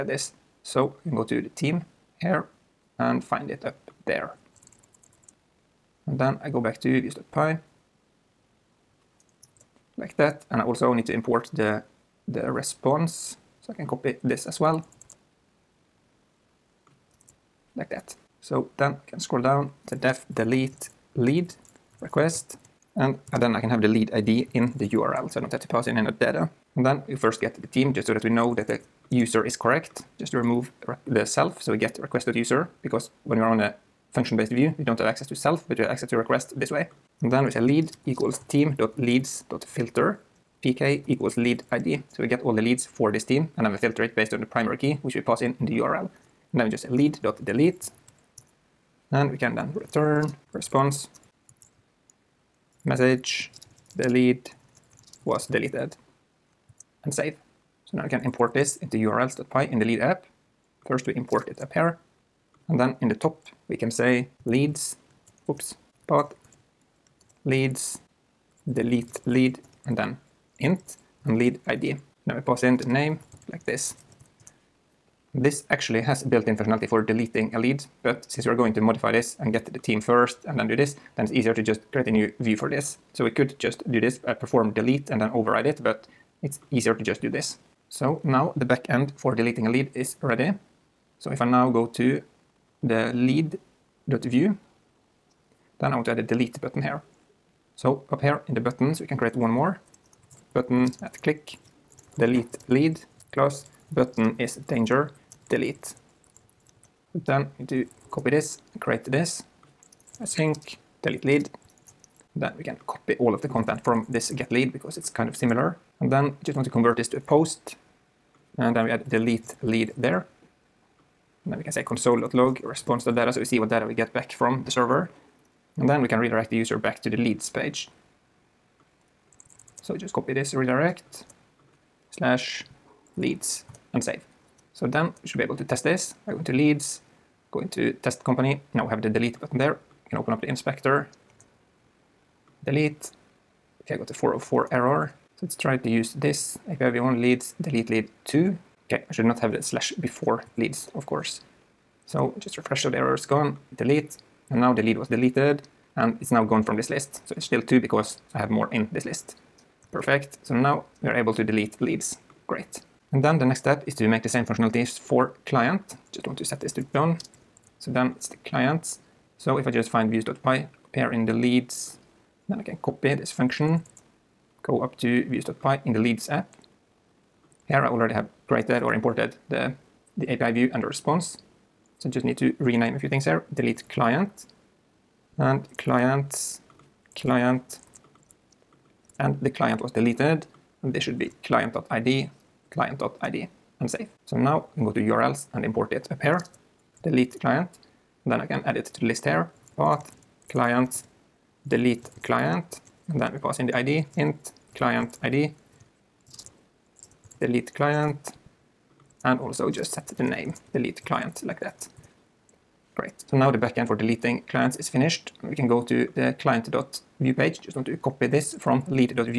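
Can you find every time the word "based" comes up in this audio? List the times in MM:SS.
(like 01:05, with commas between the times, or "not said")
00:34, 00:44.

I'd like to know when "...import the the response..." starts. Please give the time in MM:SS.
00:11.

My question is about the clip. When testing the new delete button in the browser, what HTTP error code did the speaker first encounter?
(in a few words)
404.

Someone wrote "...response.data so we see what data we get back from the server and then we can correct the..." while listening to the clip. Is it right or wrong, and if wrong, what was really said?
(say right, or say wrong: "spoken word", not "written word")
wrong: "redirect", not "correct".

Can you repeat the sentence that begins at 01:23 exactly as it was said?
So we could just do this, uh, perform delete and then override it, but it's easier to just do this.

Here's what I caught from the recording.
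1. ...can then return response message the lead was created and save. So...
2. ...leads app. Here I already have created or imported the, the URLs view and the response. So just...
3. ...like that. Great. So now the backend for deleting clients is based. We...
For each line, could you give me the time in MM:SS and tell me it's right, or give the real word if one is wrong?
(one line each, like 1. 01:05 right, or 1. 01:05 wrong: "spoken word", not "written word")
1. 00:49 wrong: "deleted", not "created"
2. 02:55 wrong: "API", not "URLs"
3. 03:31 wrong: "finished", not "based".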